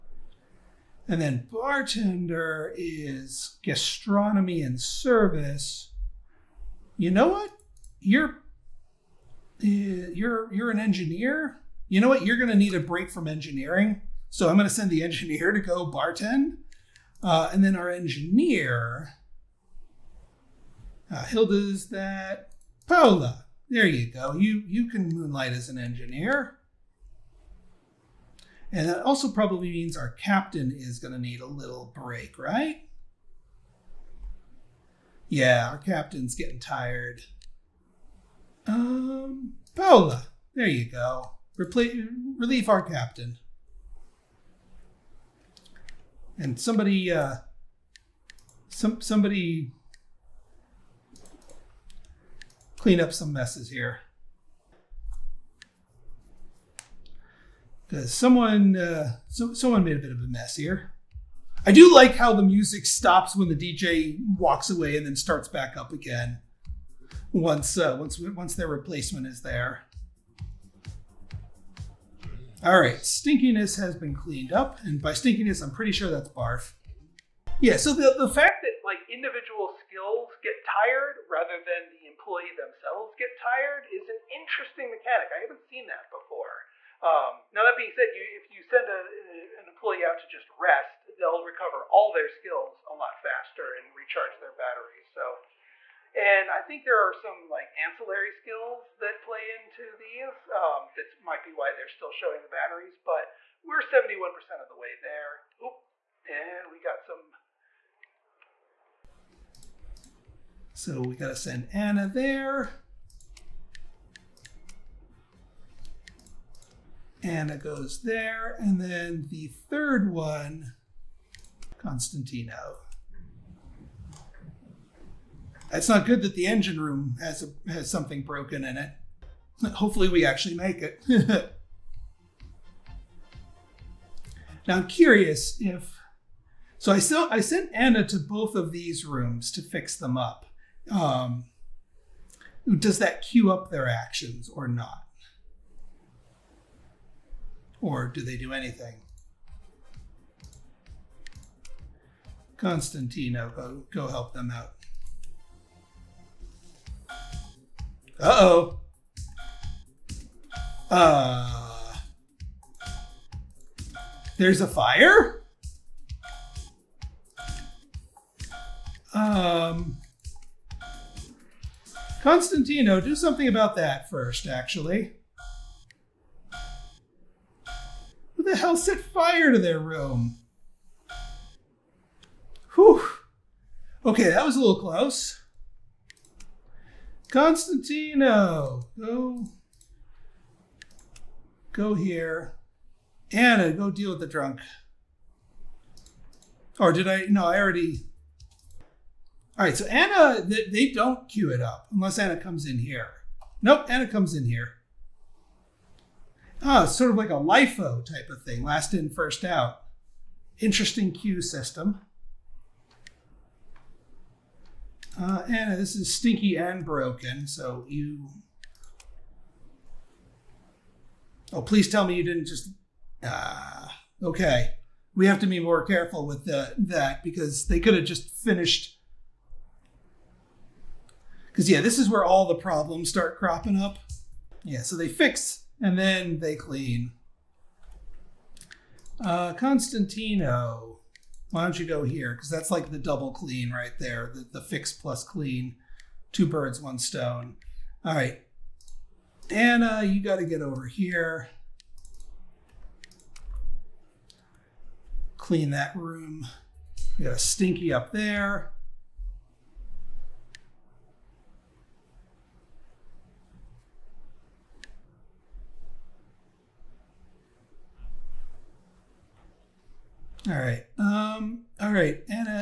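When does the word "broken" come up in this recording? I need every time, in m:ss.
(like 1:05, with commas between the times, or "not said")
2:08, 3:36.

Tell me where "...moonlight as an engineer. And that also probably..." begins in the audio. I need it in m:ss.
0:25.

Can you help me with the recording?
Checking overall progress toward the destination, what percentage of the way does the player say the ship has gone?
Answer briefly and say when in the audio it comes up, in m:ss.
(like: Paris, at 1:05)
71%, at 1:43.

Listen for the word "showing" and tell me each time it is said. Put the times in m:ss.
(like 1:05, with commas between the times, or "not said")
1:42.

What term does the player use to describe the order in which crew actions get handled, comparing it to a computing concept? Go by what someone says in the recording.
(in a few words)
LIFO.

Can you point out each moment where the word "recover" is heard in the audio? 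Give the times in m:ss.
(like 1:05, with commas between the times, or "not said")
1:31.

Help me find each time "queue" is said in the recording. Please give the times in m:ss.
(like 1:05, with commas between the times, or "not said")
3:21, 3:31.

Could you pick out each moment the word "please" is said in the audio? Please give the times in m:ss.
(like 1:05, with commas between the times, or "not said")
3:41.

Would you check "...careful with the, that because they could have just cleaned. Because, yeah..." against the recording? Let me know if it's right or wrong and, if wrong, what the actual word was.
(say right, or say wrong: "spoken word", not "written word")
wrong: "finished", not "cleaned".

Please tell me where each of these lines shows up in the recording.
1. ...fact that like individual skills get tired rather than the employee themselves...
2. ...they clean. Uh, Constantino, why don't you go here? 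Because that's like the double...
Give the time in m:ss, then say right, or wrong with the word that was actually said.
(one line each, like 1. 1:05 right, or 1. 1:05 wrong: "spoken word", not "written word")
1. 1:18 right
2. 3:56 right.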